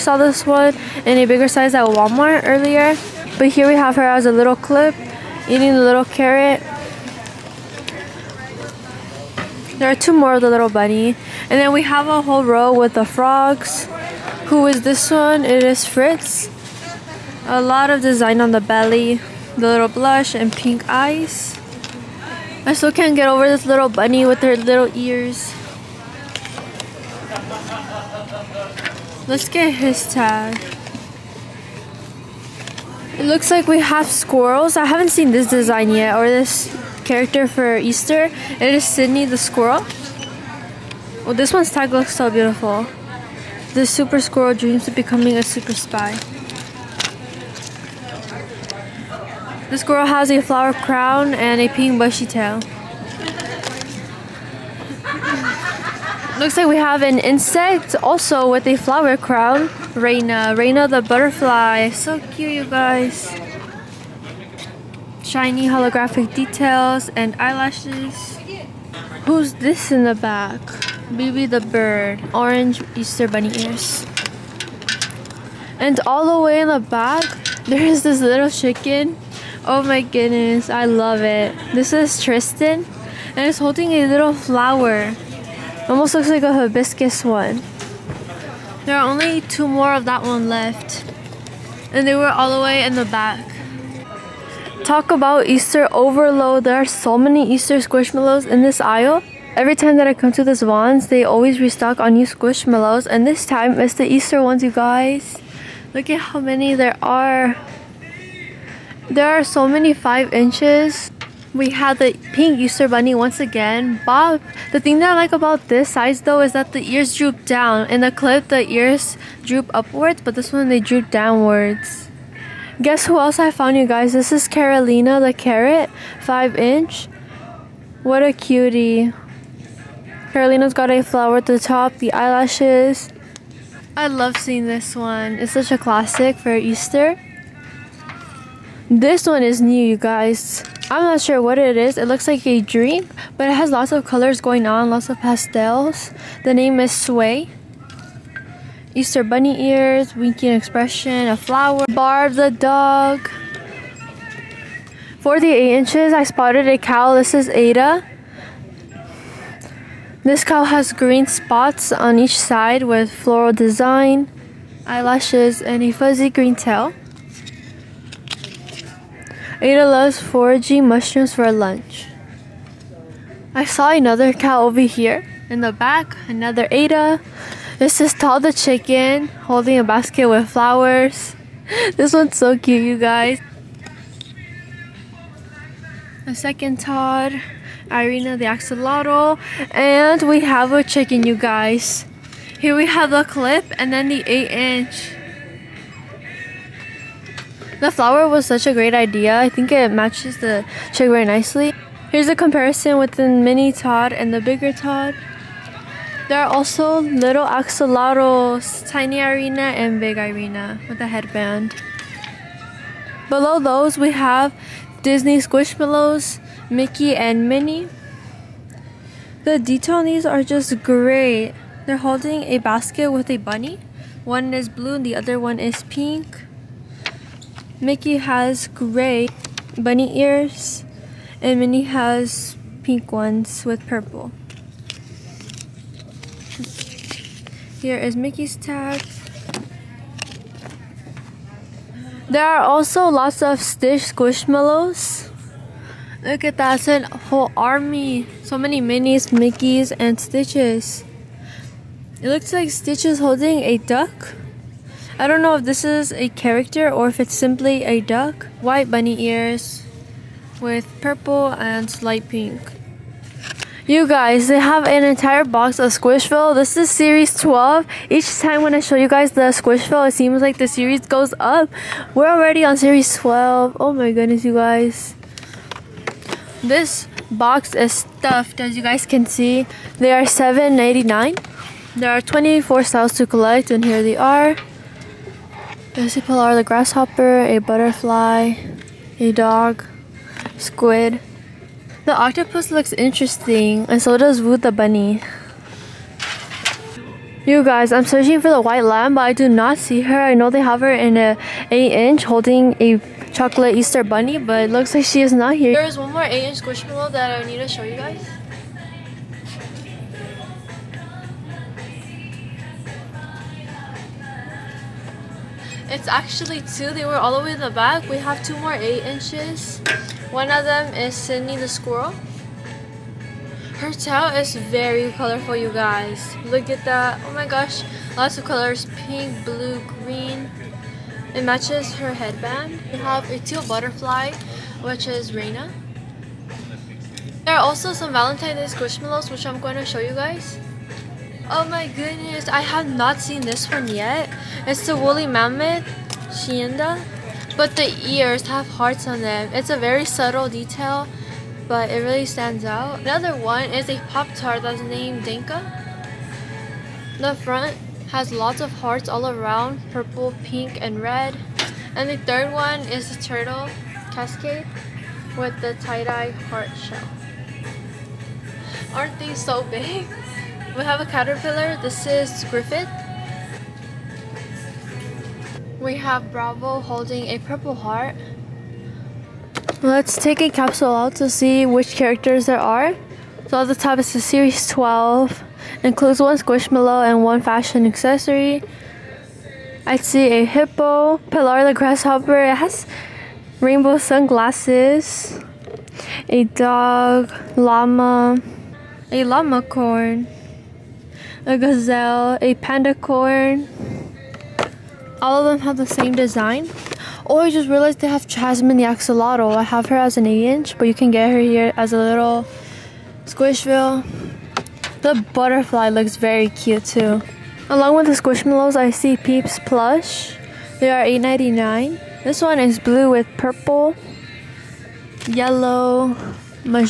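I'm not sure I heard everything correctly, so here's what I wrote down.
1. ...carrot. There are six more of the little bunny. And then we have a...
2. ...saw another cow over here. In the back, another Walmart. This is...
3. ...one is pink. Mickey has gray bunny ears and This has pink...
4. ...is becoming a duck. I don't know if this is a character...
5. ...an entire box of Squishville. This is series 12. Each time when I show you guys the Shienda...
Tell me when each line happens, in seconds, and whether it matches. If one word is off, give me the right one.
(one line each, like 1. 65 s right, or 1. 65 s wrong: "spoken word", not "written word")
1. 6 s wrong: "two", not "six"
2. 173 s wrong: "Ada", not "Walmart"
3. 225 s wrong: "Minnie", not "This"
4. 253 s wrong: "holding", not "becoming"
5. 264 s wrong: "Squishville", not "Shienda".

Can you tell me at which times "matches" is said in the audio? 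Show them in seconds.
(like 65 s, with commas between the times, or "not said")
199 s, 331 s.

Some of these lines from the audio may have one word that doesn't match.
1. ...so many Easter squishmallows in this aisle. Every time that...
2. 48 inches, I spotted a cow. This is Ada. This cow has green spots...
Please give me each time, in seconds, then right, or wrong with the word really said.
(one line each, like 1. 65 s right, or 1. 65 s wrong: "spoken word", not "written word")
1. 96 s right
2. 155 s right.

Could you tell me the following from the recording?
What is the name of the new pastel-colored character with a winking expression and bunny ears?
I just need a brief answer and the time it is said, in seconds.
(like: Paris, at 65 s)
Sway, at 146 s.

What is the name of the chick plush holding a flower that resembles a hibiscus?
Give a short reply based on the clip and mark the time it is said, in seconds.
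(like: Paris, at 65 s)
Tristan, at 81 s.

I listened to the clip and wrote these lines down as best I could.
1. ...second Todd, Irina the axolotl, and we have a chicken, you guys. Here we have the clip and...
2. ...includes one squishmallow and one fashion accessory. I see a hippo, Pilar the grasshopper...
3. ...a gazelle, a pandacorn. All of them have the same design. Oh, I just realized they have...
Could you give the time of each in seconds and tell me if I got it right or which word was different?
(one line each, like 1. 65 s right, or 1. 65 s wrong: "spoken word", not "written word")
1. 186 s right
2. 385 s right
3. 401 s right.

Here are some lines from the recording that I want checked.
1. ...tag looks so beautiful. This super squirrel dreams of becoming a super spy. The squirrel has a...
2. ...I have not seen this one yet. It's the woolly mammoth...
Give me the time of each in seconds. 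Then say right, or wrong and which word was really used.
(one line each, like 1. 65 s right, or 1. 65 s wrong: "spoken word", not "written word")
1. 41 s right
2. 342 s right.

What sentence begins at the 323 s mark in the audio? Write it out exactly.
Her tail is very colorful, you guys.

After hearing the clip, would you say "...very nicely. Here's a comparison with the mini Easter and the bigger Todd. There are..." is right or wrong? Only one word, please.
wrong.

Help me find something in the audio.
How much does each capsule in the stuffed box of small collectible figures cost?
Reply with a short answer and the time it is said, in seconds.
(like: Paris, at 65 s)
$7.99, at 280 s.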